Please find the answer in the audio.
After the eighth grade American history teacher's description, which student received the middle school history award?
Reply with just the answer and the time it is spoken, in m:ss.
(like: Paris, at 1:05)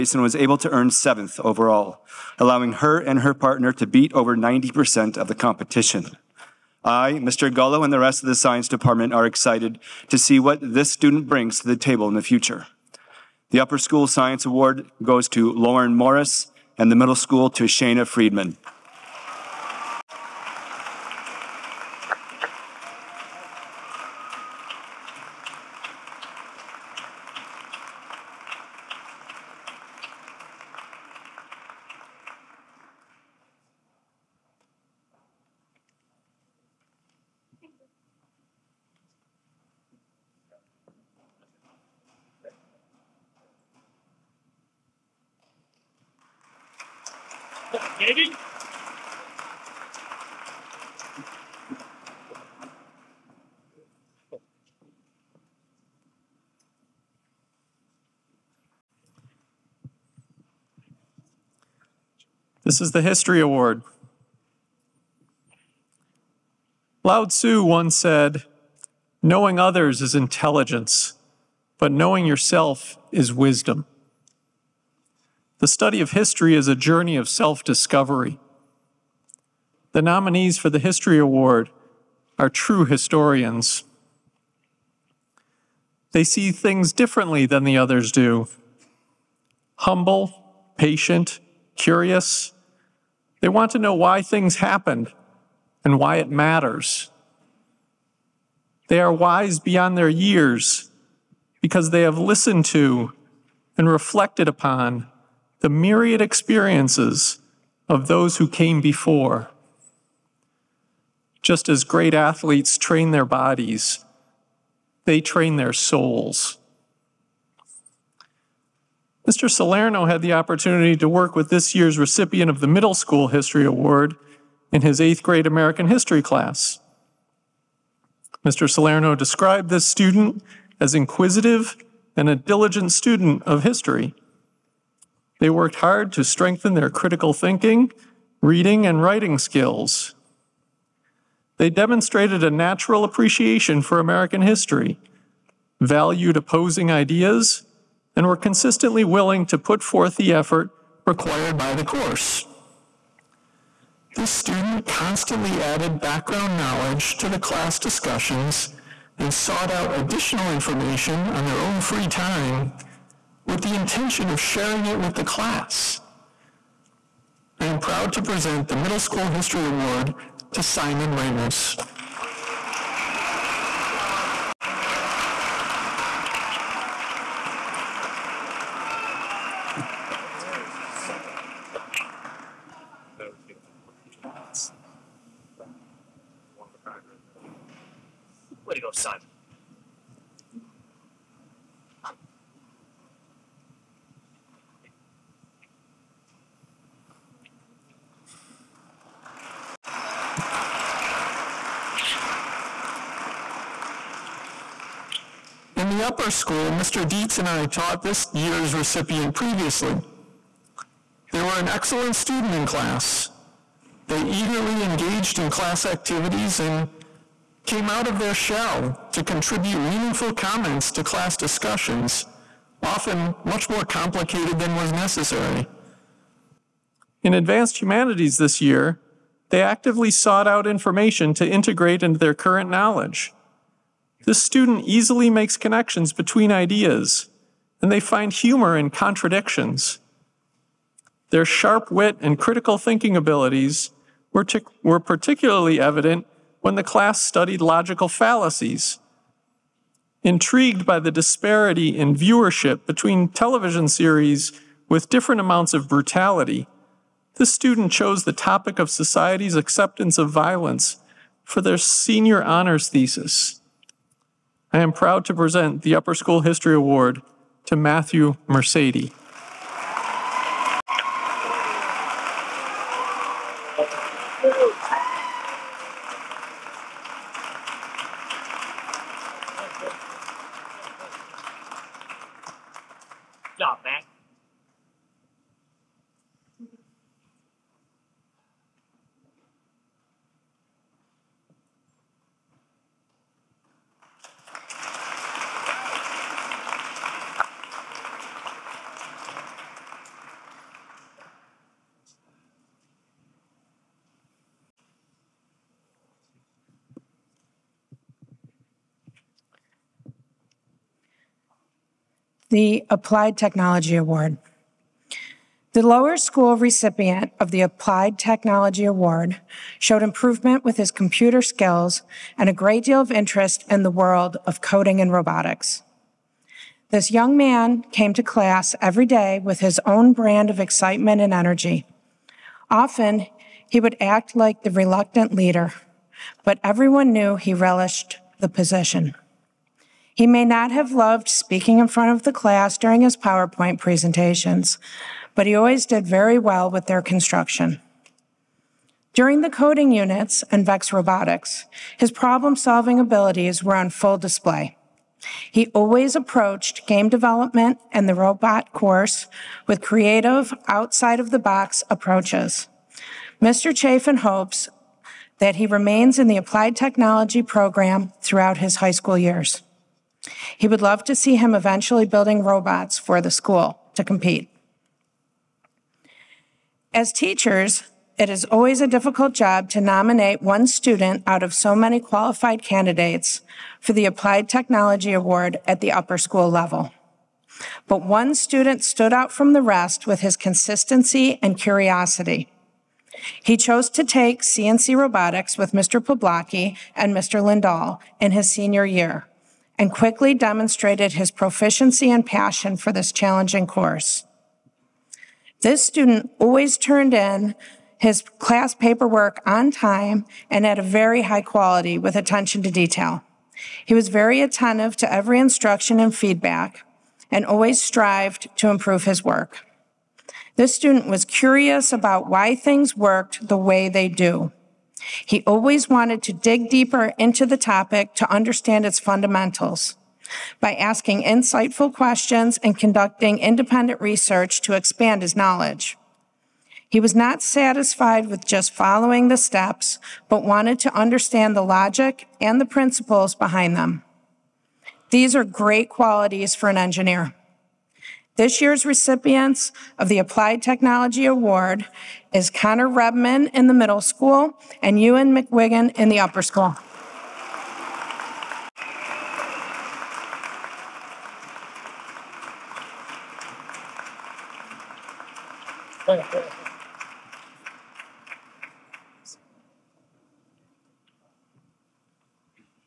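Simon Ramos, at 2:50.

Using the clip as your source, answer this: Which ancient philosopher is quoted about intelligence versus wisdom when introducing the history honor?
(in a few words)
Lao Tzu.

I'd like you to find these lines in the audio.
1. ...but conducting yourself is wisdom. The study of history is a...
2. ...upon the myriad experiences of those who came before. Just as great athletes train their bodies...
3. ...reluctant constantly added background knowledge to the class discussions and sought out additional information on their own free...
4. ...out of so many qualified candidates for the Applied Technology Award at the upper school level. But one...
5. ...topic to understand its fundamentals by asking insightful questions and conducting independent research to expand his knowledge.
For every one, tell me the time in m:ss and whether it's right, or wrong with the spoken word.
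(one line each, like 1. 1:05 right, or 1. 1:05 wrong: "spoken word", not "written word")
1. 1:11 wrong: "knowing", not "conducting"
2. 1:44 right
3. 2:34 wrong: "student", not "reluctant"
4. 6:21 right
5. 7:07 right.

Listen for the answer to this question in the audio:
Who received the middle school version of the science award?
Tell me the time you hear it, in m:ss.
0:17.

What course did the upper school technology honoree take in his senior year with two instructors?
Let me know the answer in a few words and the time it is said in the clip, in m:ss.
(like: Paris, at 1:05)
CNC robotics, at 6:34.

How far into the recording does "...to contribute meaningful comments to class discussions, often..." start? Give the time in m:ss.
3:39.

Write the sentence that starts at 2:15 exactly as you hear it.
They worked hard to strengthen their critical thinking, reading, and writing skills.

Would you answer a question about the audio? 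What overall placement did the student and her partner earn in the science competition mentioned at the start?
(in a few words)
seventh.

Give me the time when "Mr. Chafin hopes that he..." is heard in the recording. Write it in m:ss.
6:03.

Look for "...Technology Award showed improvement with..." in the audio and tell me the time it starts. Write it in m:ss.
5:18.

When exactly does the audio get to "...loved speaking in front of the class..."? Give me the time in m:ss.
5:40.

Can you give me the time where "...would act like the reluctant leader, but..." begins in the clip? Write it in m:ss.
5:33.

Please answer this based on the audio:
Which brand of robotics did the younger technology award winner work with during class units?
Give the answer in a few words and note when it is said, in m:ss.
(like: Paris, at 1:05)
VEX, at 5:50.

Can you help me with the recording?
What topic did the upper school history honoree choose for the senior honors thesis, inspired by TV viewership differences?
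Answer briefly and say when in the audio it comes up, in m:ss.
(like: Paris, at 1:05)
society's acceptance of violence, at 4:18.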